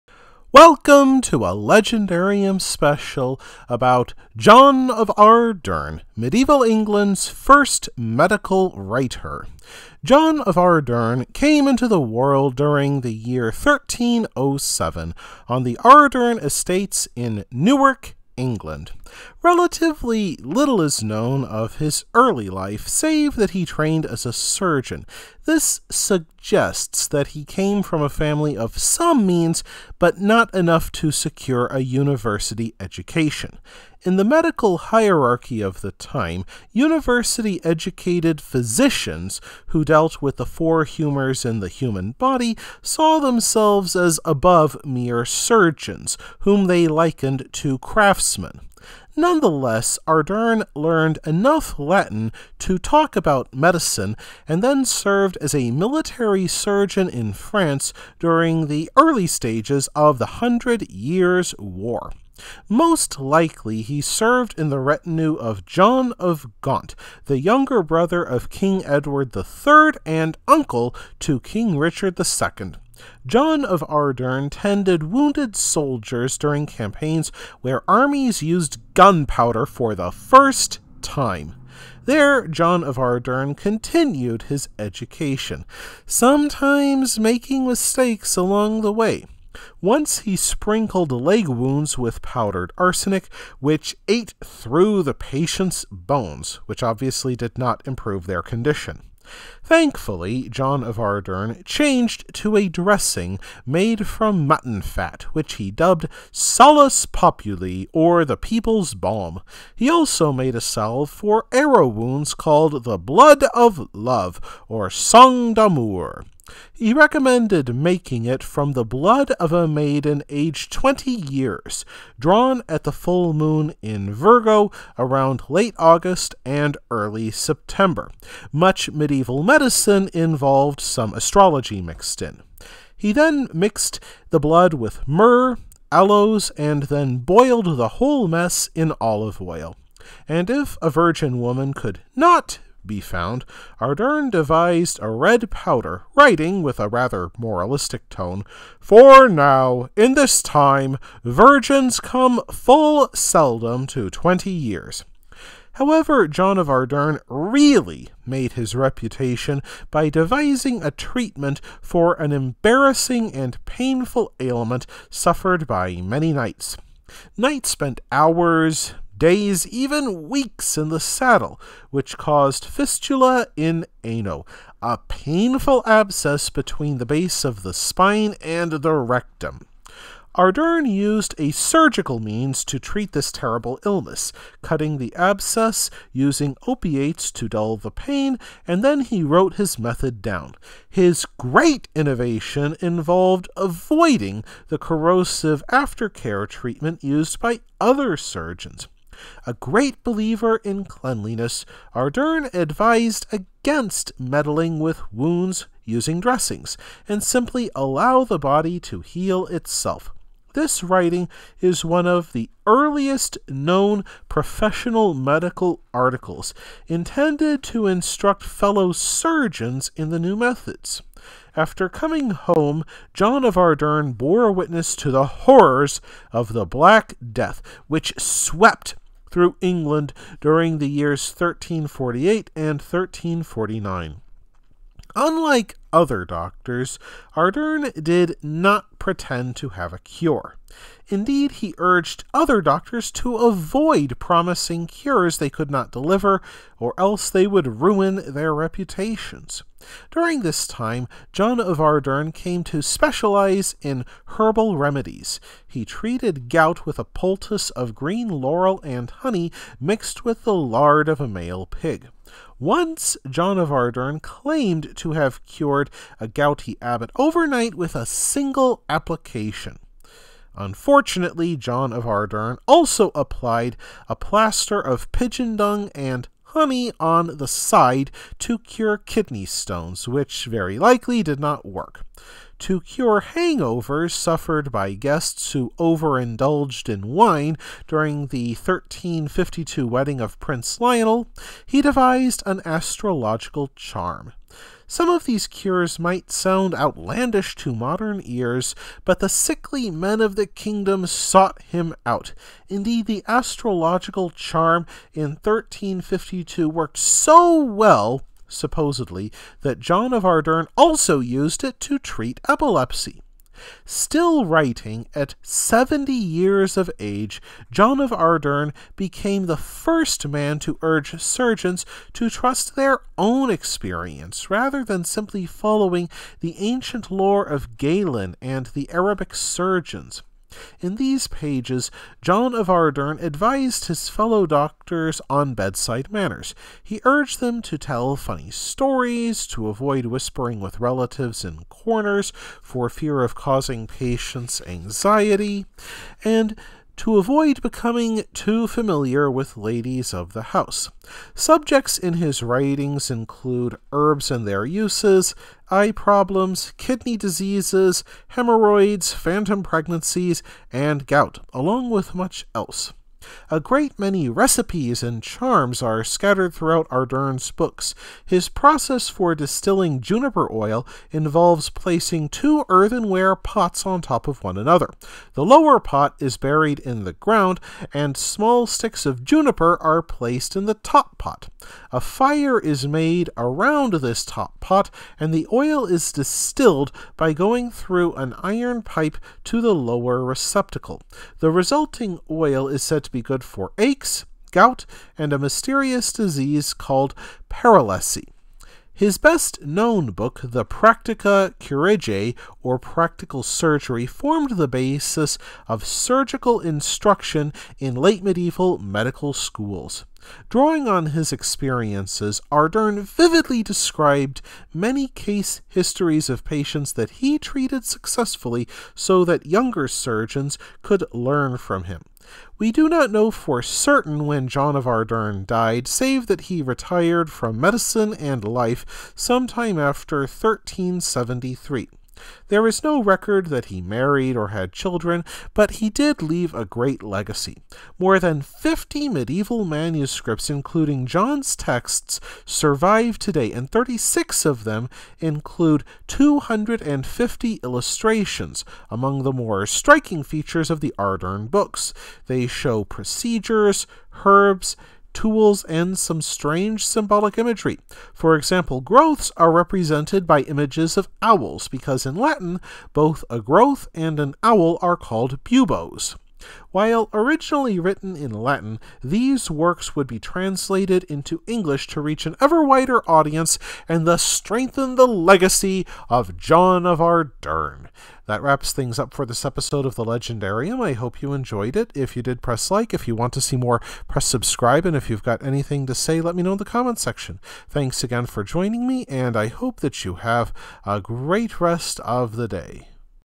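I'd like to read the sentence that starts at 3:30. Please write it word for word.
This writing is one of the earliest known professional medical articles intended to instruct fellow surgeons in the new methods.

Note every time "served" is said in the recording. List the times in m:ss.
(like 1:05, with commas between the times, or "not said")
0:54, 1:04.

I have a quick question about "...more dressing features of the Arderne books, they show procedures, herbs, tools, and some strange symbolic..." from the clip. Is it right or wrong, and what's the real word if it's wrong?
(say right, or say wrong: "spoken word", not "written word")
wrong: "striking", not "dressing".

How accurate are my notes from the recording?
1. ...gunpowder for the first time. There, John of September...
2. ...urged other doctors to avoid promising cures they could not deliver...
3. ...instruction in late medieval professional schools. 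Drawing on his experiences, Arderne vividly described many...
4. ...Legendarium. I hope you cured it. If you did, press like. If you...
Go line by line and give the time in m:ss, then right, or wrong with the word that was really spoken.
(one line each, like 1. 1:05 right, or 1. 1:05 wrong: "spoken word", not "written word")
1. 1:18 wrong: "Arderne", not "September"
2. 4:01 right
3. 6:46 wrong: "medical", not "professional"
4. 8:00 wrong: "enjoyed", not "cured".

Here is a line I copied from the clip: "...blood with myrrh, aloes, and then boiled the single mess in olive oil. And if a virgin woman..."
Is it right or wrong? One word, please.
wrong.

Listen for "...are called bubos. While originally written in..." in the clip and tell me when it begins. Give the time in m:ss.
7:44.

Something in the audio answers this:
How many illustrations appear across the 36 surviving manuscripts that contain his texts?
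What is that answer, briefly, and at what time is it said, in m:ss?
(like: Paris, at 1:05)
250, at 7:26.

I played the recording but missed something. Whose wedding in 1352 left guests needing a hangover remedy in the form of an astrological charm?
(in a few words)
Prince Lionel.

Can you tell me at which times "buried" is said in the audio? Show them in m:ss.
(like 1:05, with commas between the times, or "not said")
6:16.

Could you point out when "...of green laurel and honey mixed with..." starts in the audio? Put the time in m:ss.
4:17.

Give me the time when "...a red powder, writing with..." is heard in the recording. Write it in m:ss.
2:25.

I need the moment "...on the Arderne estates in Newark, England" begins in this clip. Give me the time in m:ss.
0:15.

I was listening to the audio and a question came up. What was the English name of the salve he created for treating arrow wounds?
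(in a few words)
Blood of Love.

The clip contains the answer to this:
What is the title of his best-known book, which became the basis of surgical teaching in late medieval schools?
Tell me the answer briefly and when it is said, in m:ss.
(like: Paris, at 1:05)
Practica Chirurgiae, at 6:40.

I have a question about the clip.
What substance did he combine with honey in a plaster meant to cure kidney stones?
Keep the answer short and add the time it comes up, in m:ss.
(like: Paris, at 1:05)
Pigeon dung, at 4:35.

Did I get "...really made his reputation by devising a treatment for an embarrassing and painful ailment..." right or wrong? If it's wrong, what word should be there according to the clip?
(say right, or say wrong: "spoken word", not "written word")
right.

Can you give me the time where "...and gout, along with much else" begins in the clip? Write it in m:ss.
6:00.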